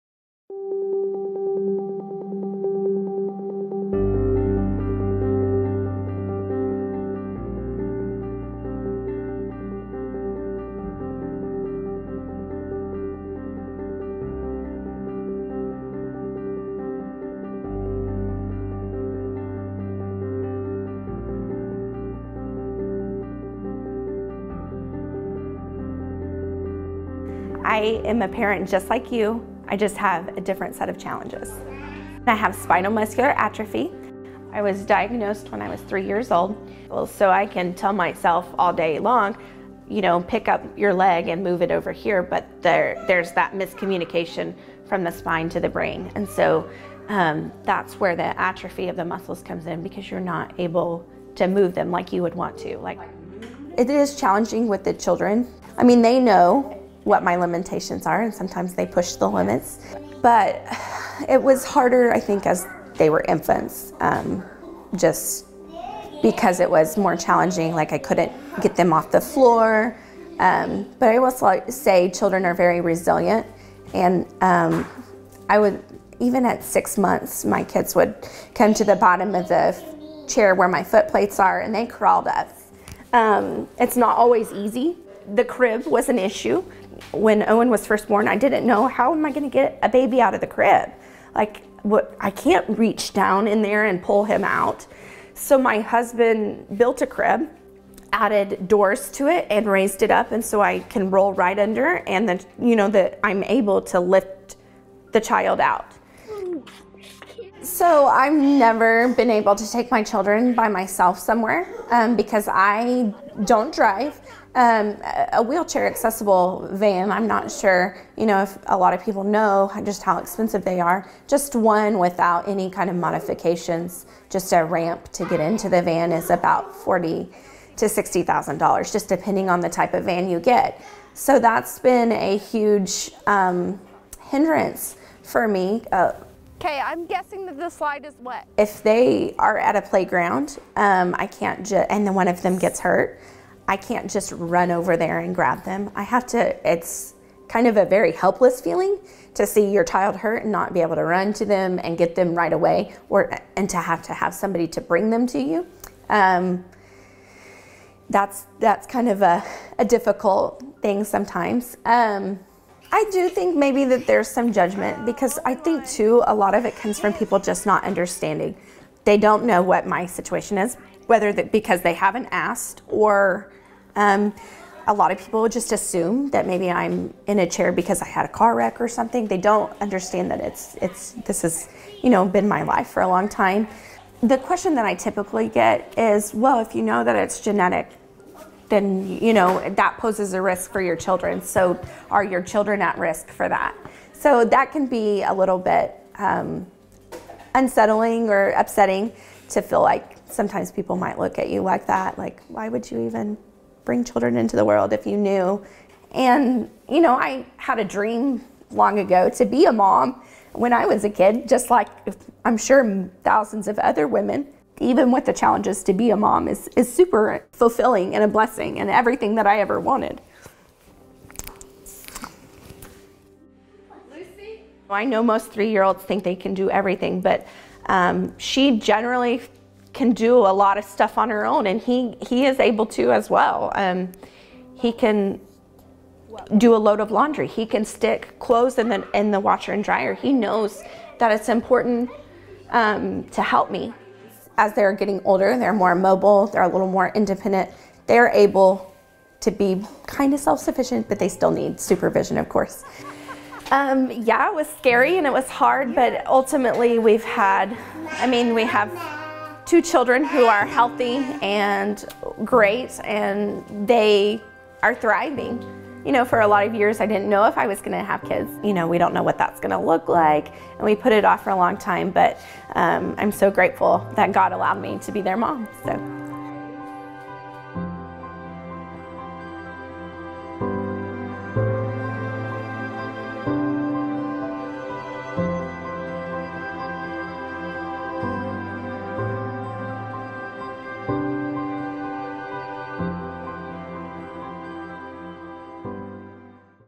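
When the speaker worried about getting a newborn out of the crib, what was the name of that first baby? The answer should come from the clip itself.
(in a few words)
Owen.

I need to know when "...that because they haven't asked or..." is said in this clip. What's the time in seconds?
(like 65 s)
171 s.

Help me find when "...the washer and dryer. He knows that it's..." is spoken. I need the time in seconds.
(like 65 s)
239 s.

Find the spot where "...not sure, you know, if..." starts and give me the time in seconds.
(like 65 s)
117 s.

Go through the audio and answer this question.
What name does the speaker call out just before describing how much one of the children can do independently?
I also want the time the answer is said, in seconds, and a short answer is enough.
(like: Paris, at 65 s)
Lucy, at 224 s.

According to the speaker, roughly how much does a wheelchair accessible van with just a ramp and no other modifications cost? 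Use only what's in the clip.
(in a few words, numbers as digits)
$40,000 to $60,000.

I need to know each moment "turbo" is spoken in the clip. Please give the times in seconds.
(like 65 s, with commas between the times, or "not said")
not said.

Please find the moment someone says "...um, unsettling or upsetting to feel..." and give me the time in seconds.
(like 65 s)
196 s.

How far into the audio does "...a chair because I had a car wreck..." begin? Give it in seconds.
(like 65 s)
177 s.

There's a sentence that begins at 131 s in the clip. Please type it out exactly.
So that's been a huge um, hindrance for me.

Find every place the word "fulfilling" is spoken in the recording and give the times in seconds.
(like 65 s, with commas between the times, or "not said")
217 s.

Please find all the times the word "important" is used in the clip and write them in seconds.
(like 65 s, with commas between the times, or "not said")
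241 s.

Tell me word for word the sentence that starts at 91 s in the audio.
Like what I can't reach down in there and pull him out.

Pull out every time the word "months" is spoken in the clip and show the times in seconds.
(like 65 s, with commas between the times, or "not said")
76 s.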